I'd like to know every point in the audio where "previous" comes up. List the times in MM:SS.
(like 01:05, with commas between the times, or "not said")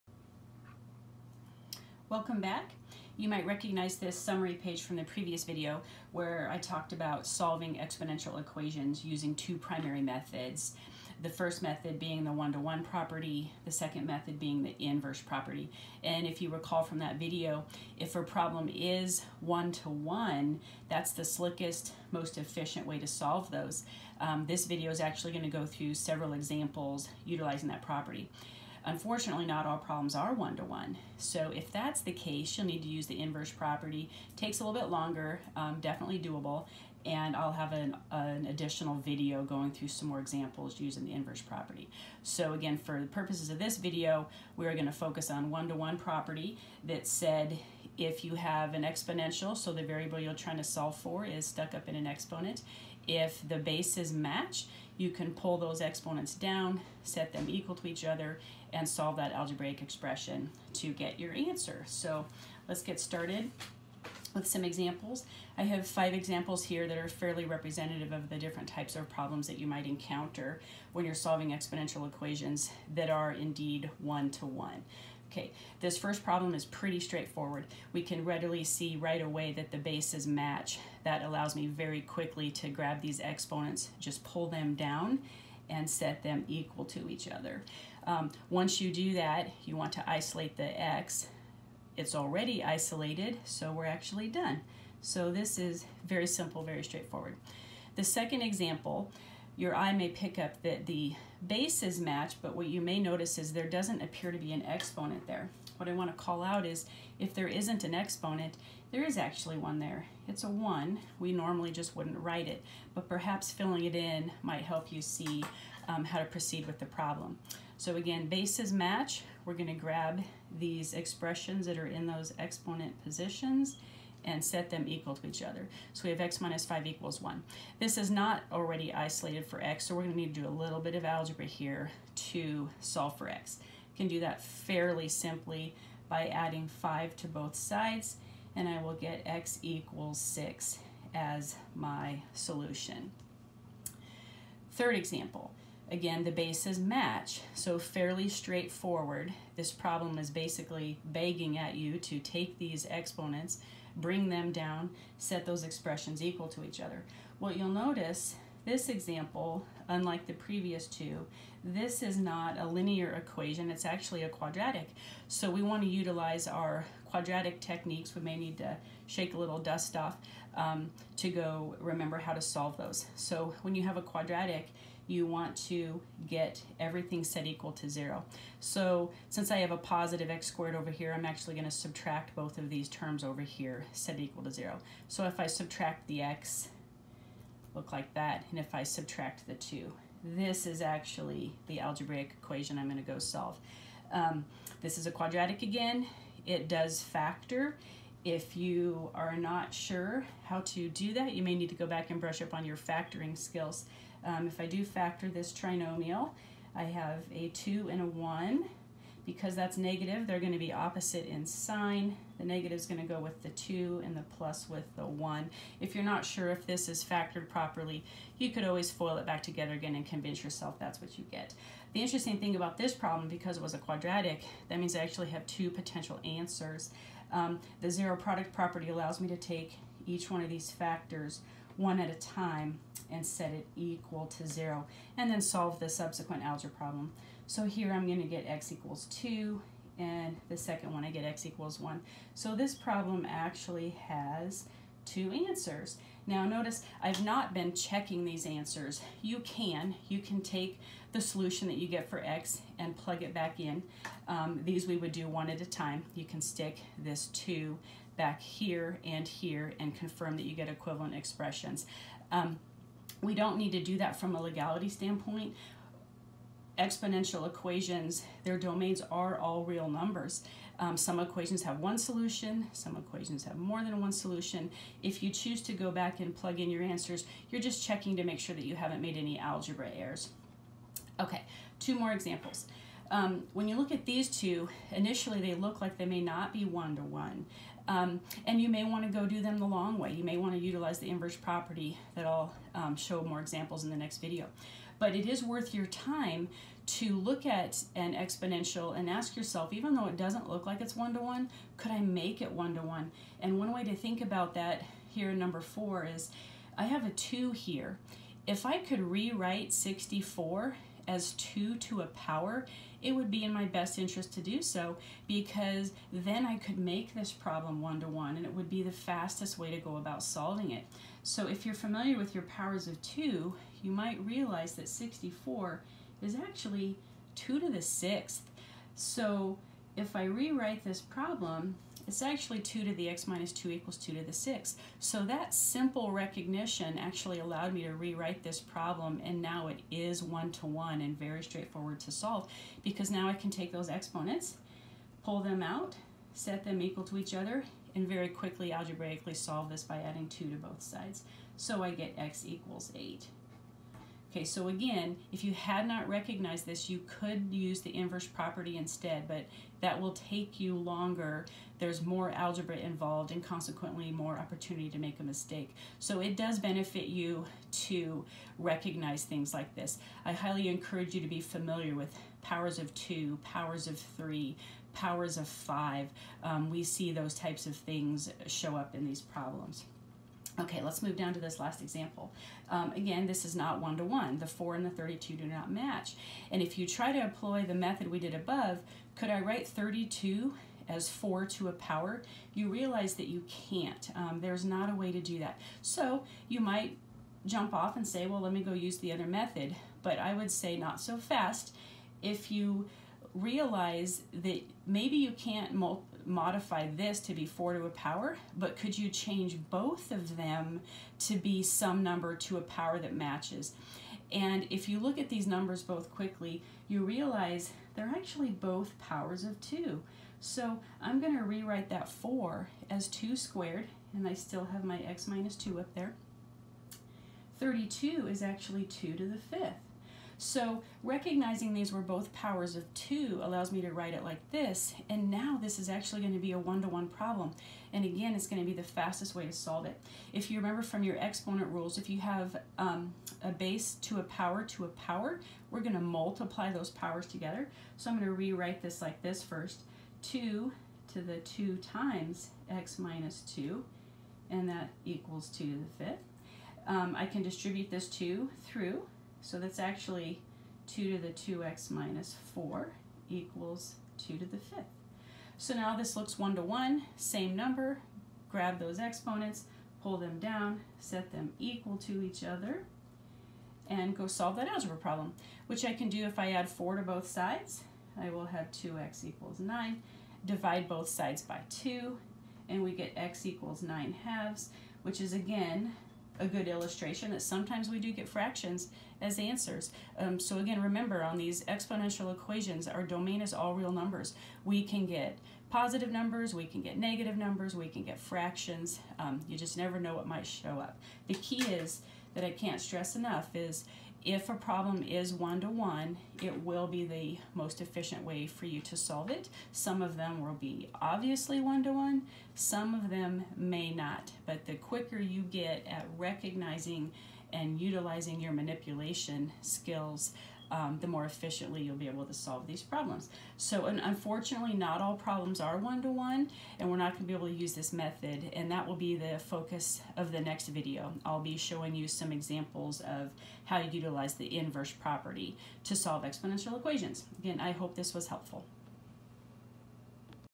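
00:05, 02:40.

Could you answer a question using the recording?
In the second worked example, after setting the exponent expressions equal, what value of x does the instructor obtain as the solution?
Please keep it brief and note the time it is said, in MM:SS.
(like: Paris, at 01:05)
x = 6, at 02:19.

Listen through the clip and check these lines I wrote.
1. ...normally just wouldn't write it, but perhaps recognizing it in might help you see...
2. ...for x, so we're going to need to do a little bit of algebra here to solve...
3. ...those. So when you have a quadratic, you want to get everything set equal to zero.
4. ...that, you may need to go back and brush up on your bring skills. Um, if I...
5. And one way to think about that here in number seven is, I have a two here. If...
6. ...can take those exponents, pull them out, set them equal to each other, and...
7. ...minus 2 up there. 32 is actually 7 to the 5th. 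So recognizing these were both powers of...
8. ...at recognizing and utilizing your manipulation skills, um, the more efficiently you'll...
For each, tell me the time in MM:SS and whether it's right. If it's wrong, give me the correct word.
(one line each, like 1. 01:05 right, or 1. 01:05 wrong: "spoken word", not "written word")
1. 01:51 wrong: "filling", not "recognizing"
2. 02:09 right
3. 02:52 right
4. 03:21 wrong: "factoring", not "bring"
5. 05:03 wrong: "four", not "seven"
6. 05:43 right
7. 07:05 wrong: "2", not "7"
8. 08:35 right.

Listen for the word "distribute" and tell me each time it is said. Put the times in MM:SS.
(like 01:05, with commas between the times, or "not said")
07:37.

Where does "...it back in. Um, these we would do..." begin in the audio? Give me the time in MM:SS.
04:13.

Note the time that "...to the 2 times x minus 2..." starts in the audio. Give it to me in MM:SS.
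07:31.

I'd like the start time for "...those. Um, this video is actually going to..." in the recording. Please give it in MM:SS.
00:23.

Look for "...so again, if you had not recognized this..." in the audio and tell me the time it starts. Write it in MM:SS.
05:54.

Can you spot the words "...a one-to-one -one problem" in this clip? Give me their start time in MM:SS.
07:16.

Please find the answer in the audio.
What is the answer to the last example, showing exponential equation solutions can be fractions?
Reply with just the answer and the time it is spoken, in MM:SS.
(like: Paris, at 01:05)
9/2, at 08:03.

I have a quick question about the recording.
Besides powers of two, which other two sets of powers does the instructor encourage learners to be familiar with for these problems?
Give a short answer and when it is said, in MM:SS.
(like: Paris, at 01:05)
powers of 3 and 5, at 06:13.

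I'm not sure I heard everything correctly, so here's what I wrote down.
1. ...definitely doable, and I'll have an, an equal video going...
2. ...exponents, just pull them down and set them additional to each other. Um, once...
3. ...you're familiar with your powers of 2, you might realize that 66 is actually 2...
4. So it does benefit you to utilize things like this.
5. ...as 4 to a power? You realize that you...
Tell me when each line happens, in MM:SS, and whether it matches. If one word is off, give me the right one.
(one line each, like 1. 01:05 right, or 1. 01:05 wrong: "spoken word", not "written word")
1. 00:35 wrong: "additional", not "equal"
2. 01:23 wrong: "equal", not "additional"
3. 05:21 wrong: "64", not "66"
4. 06:05 wrong: "recognize", not "utilize"
5. 06:30 right.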